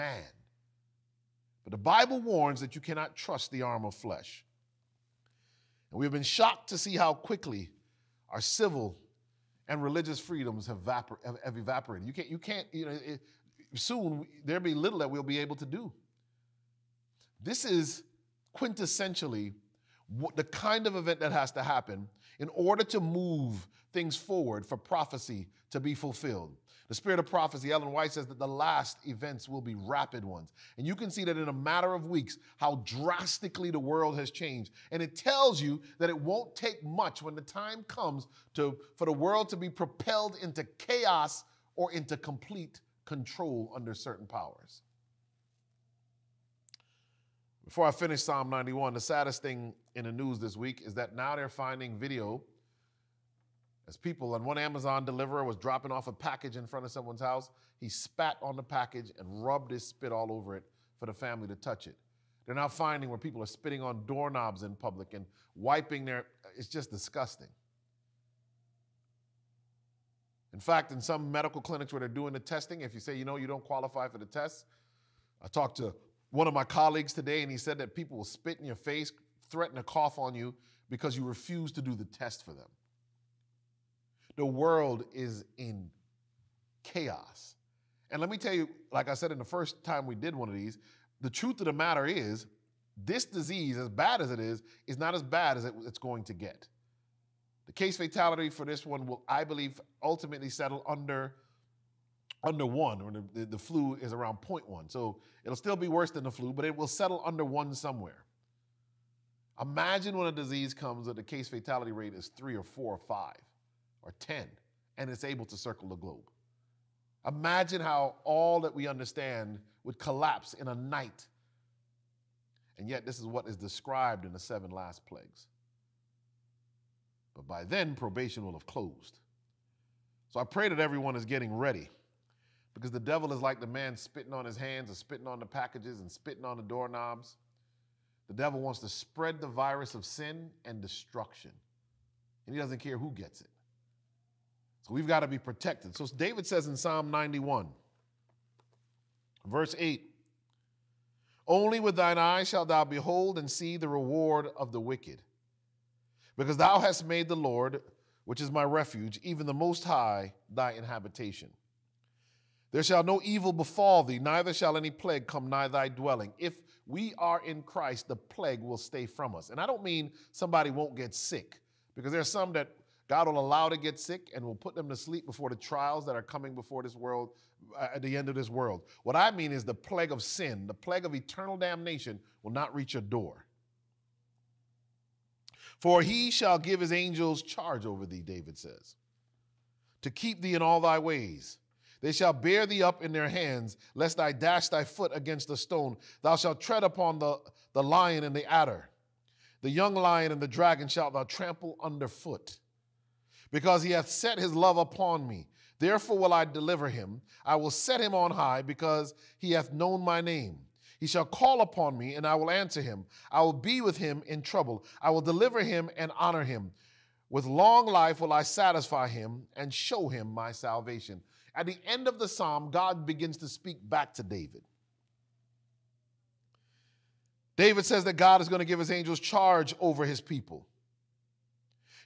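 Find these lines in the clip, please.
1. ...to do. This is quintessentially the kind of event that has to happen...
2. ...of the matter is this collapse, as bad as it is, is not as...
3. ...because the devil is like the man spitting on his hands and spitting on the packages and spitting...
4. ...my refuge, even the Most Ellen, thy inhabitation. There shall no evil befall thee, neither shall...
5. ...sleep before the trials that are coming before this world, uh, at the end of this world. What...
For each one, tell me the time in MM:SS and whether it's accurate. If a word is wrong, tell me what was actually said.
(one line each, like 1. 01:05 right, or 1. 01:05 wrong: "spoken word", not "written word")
1. 00:15 right
2. 01:31 wrong: "disease", not "collapse"
3. 02:12 right
4. 02:38 wrong: "High", not "Ellen"
5. 02:54 right.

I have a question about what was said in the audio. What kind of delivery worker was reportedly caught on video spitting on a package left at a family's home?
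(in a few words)
Amazon.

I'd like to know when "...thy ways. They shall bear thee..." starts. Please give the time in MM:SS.
03:10.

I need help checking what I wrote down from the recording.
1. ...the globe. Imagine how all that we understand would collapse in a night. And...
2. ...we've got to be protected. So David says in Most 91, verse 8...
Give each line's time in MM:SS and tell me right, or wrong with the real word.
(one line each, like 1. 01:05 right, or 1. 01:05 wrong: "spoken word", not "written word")
1. 01:55 right
2. 02:24 wrong: "Psalm", not "Most".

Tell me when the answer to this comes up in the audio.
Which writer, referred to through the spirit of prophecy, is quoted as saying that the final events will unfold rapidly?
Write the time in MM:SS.
00:27.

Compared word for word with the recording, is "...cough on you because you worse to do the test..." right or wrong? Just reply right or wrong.
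wrong.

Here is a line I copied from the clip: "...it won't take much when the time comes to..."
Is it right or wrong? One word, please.
right.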